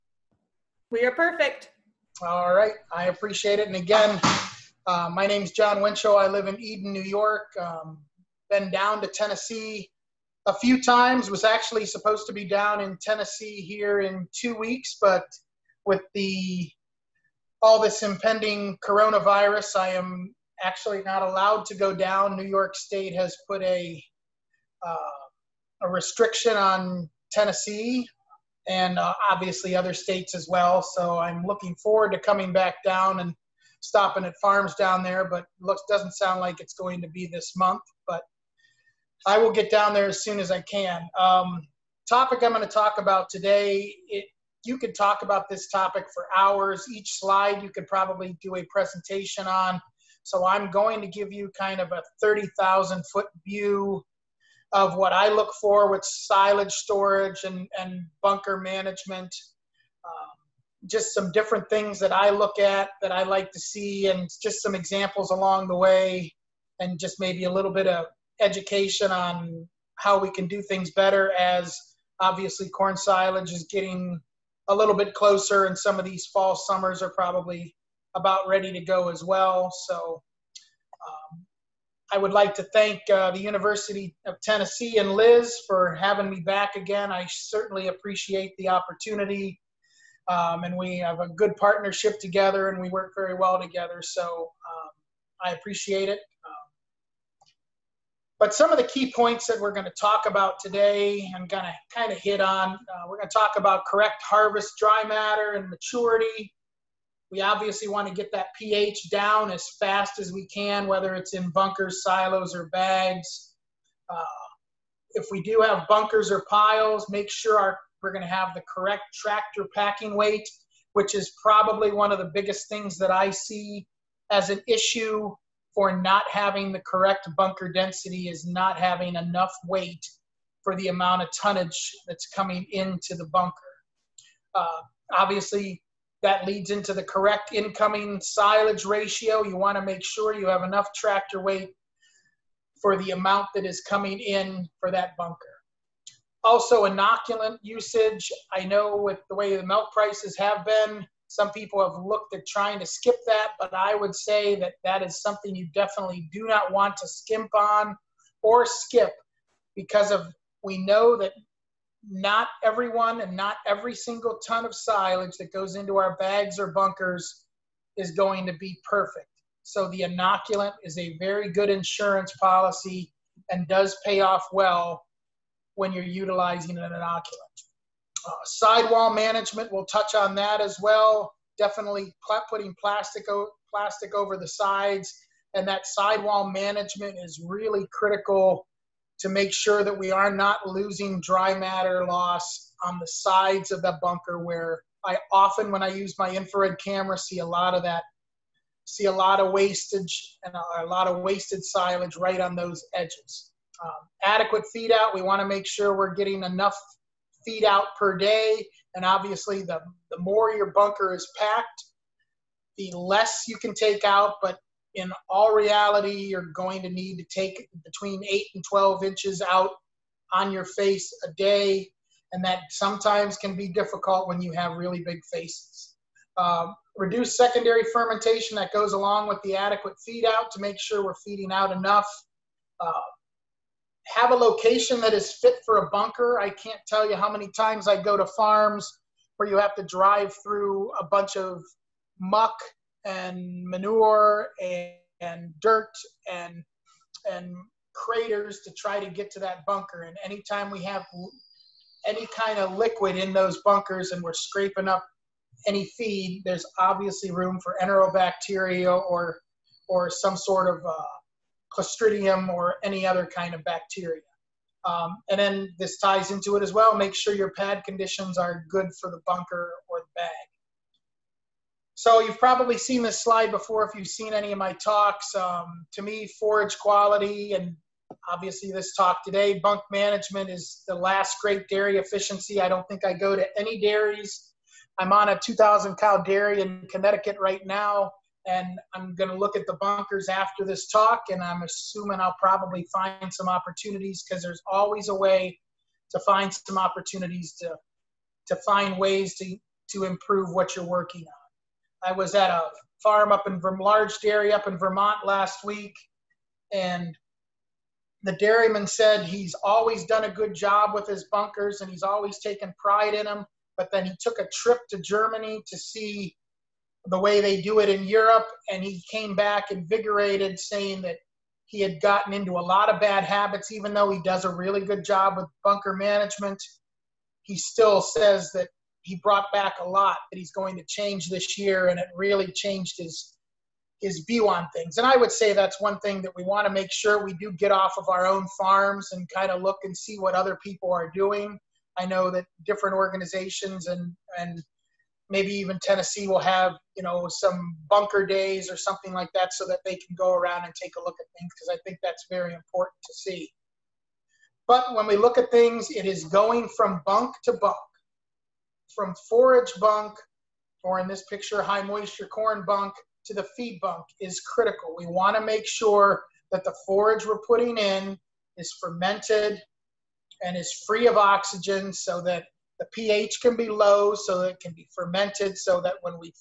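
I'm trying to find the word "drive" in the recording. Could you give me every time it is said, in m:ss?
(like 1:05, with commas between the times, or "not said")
3:59.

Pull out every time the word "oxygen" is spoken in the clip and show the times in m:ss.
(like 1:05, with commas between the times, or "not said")
6:11.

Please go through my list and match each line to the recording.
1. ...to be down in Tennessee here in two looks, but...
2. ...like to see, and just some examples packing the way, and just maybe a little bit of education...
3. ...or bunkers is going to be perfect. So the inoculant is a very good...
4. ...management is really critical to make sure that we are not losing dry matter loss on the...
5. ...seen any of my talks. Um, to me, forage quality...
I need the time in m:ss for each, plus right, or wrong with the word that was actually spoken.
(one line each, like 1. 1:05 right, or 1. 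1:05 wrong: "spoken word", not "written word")
1. 0:12 wrong: "weeks", not "looks"
2. 1:03 wrong: "along", not "packing"
3. 2:46 right
4. 3:06 right
5. 4:34 right.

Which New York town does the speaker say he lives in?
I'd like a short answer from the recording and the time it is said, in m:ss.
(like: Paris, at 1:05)
Eden, New York, at 0:06.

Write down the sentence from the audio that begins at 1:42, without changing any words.
Uh, we're going to talk about correct harvest dry matter and maturity.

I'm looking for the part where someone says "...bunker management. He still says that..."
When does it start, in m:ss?
5:25.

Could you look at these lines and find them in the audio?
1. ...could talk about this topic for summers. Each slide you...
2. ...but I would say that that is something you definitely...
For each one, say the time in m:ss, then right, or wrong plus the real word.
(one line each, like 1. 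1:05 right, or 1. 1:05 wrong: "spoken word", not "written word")
1. 0:44 wrong: "hours", not "summers"
2. 2:33 right.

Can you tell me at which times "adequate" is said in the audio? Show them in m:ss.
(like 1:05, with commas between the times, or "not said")
3:24, 3:49.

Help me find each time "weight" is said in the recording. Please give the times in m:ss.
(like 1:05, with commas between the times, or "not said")
2:00, 2:09, 2:21.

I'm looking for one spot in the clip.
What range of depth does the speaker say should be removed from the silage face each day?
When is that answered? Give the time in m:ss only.
3:37.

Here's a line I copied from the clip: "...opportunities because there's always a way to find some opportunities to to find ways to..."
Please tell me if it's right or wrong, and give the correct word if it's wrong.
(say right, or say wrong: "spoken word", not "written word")
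right.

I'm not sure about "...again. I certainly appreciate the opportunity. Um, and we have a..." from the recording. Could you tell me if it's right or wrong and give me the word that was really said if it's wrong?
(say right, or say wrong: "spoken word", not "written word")
right.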